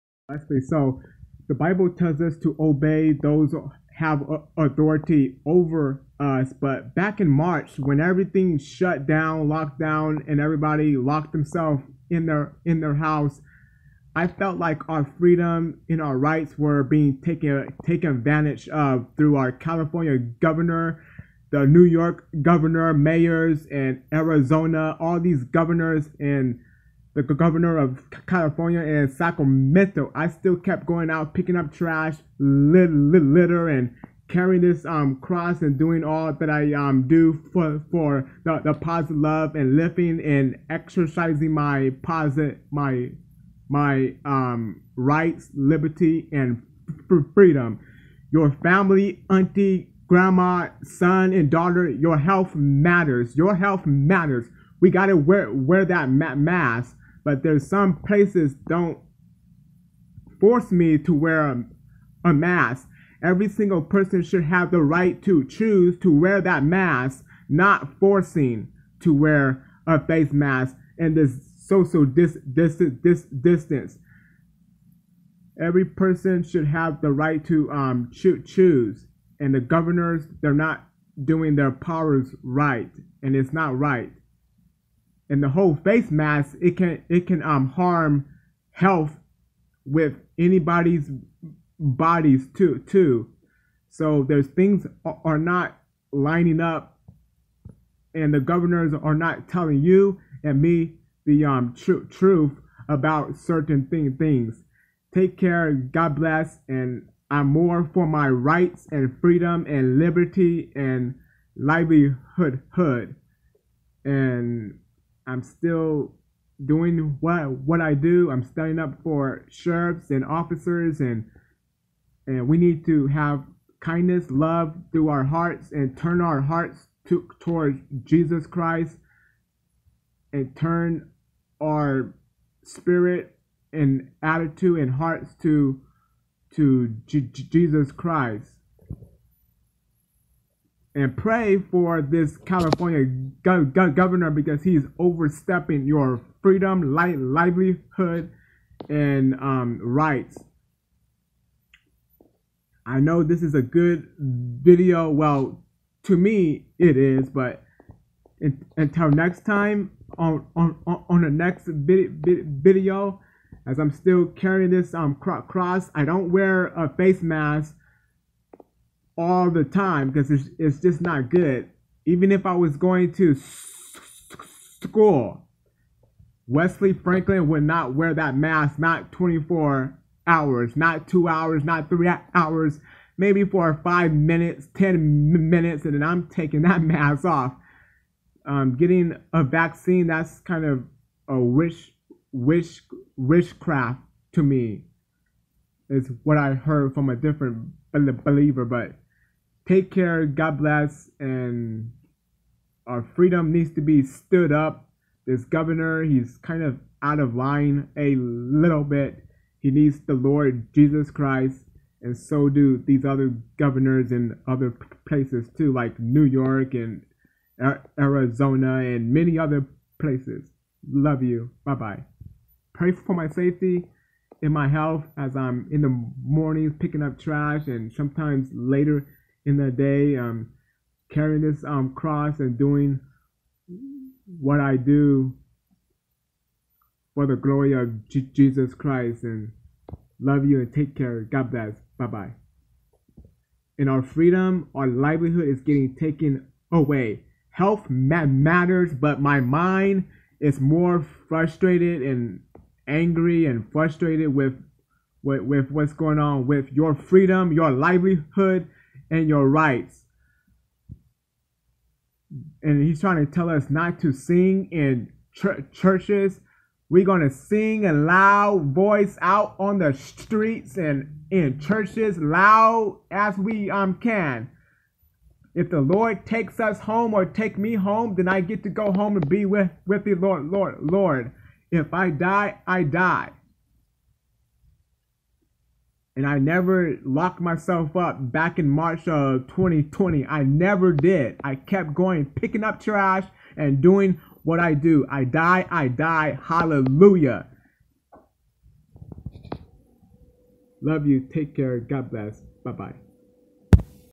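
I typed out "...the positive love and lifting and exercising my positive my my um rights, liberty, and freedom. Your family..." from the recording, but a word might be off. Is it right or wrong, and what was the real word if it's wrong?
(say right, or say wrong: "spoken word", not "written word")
right.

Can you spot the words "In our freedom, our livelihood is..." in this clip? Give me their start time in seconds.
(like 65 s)
243 s.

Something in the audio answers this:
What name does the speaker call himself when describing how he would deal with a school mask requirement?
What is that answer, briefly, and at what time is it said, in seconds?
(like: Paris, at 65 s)
Wesley Franklin, at 176 s.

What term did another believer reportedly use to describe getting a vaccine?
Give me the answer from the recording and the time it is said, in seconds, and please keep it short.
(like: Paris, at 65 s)
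Wishcraft, at 193 s.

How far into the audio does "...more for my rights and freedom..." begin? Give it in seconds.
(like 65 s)
107 s.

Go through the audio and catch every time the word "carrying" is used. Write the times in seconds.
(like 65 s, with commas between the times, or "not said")
34 s, 164 s, 231 s.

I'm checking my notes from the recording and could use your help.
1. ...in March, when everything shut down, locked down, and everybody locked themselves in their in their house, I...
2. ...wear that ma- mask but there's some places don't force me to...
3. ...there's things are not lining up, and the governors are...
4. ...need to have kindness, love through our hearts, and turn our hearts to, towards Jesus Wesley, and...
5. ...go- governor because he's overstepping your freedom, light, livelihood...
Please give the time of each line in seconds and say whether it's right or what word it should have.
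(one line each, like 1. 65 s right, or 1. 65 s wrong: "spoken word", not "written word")
1. 7 s right
2. 55 s right
3. 94 s right
4. 122 s wrong: "Christ", not "Wesley"
5. 143 s right.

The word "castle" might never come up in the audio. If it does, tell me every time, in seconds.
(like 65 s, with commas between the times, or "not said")
not said.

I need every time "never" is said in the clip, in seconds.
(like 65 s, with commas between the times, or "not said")
286 s, 290 s.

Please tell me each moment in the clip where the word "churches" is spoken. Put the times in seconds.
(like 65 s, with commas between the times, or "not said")
265 s, 271 s.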